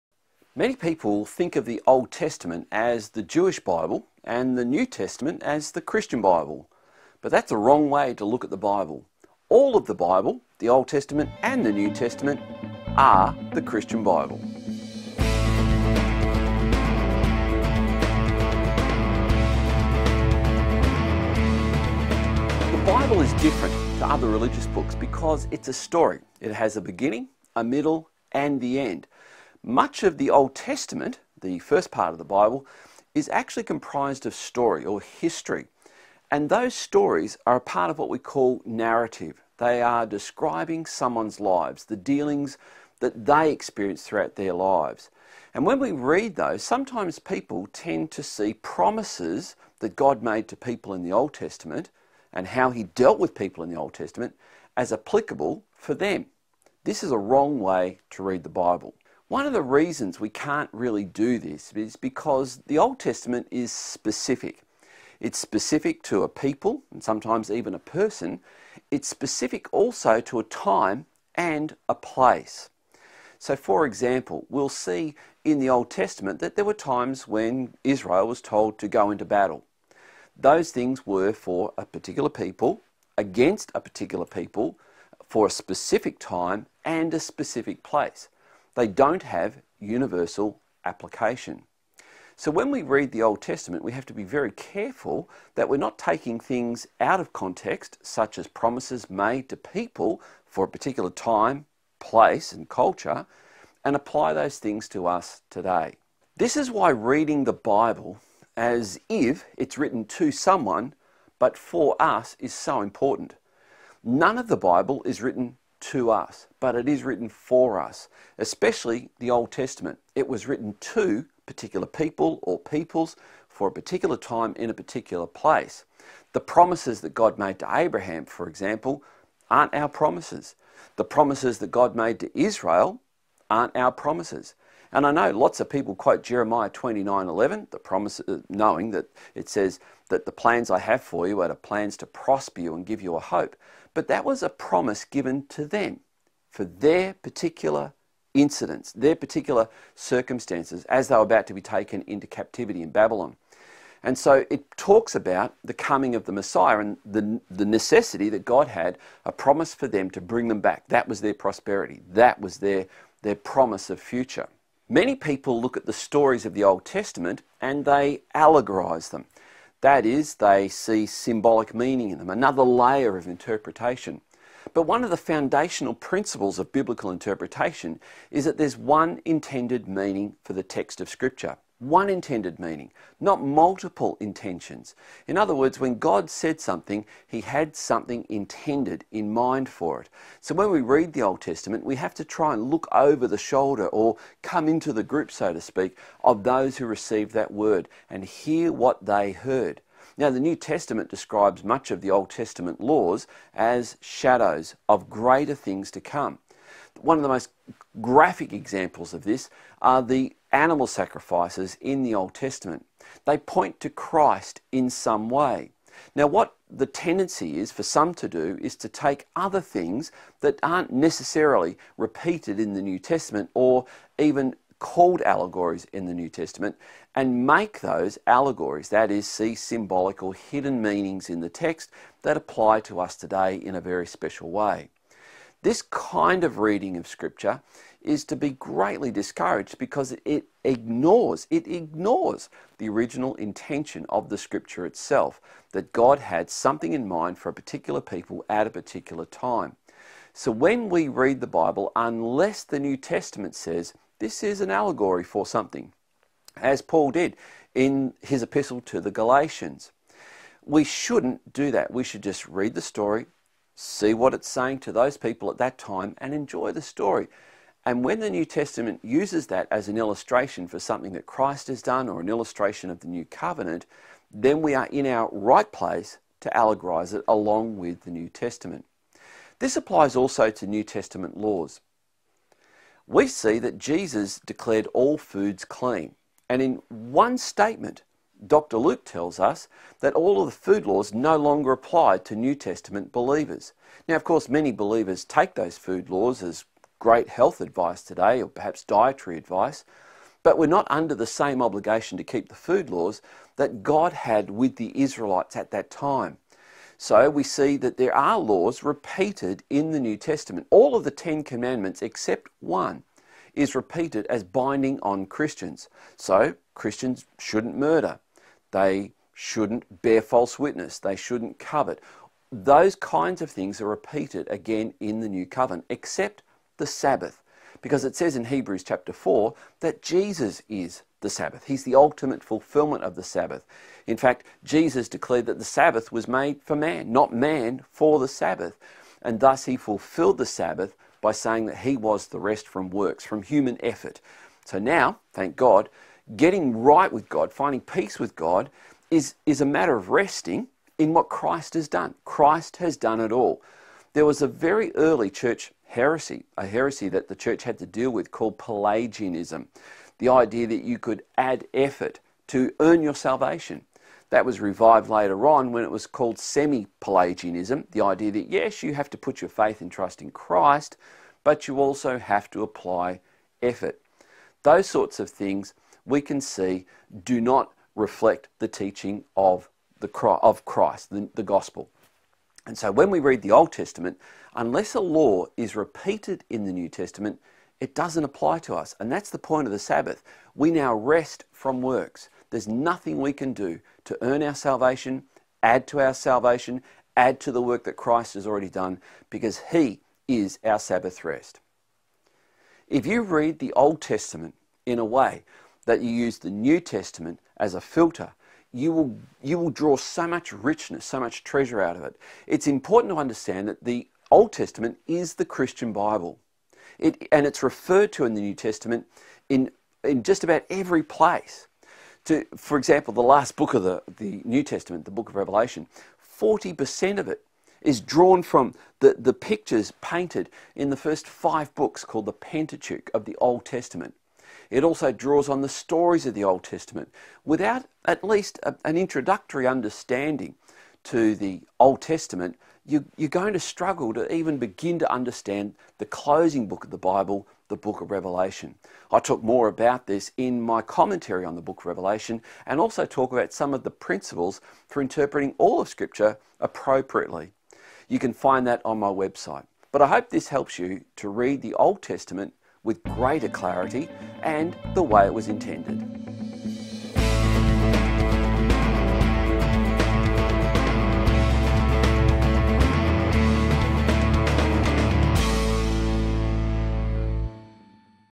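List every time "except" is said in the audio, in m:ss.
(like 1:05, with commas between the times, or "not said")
5:12, 5:25.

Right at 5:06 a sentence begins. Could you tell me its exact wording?
So we see that there are laws repeated in the New Testament.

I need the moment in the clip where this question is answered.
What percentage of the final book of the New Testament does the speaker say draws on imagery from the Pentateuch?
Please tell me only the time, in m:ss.
7:06.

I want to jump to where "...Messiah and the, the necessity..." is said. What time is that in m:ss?
2:36.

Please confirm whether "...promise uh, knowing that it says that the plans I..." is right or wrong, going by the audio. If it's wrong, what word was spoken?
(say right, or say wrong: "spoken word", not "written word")
right.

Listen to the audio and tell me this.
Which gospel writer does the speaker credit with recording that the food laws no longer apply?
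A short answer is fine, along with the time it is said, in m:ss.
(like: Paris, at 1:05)
Dr. Luke, at 4:48.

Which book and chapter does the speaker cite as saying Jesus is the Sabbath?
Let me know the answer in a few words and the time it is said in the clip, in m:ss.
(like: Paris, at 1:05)
Hebrews chapter 4, at 5:28.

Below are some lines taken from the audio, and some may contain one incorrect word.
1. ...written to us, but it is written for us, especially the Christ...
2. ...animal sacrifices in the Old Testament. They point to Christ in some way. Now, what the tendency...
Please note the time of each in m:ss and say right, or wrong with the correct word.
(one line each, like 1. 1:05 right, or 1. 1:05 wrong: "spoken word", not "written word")
1. 1:55 wrong: "Old", not "Christ"
2. 3:30 right.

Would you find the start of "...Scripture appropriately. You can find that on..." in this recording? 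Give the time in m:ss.
7:35.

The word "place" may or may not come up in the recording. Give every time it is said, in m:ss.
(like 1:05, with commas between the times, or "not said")
1:11, 1:27, 1:41, 2:05, 4:35, 7:01.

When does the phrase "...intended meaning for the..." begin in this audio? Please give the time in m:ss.
2:59.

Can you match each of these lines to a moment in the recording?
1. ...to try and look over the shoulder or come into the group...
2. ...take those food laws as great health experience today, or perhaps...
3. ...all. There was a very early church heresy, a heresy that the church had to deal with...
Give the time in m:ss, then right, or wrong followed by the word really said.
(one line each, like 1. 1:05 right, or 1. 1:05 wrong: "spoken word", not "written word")
1. 3:12 right
2. 4:55 wrong: "advice", not "experience"
3. 5:53 right.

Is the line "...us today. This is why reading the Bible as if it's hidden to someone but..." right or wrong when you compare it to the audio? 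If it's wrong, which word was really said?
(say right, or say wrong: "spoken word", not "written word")
wrong: "written", not "hidden".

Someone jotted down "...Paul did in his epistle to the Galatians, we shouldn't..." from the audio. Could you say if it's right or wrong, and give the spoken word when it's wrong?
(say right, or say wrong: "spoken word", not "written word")
right.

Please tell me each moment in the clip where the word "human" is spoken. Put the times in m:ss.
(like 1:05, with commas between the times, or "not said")
5:43.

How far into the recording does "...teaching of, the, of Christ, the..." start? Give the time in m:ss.
6:18.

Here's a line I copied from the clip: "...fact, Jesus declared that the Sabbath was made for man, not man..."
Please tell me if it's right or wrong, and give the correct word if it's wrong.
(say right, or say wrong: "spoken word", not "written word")
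right.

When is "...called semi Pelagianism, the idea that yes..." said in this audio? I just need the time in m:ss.
6:06.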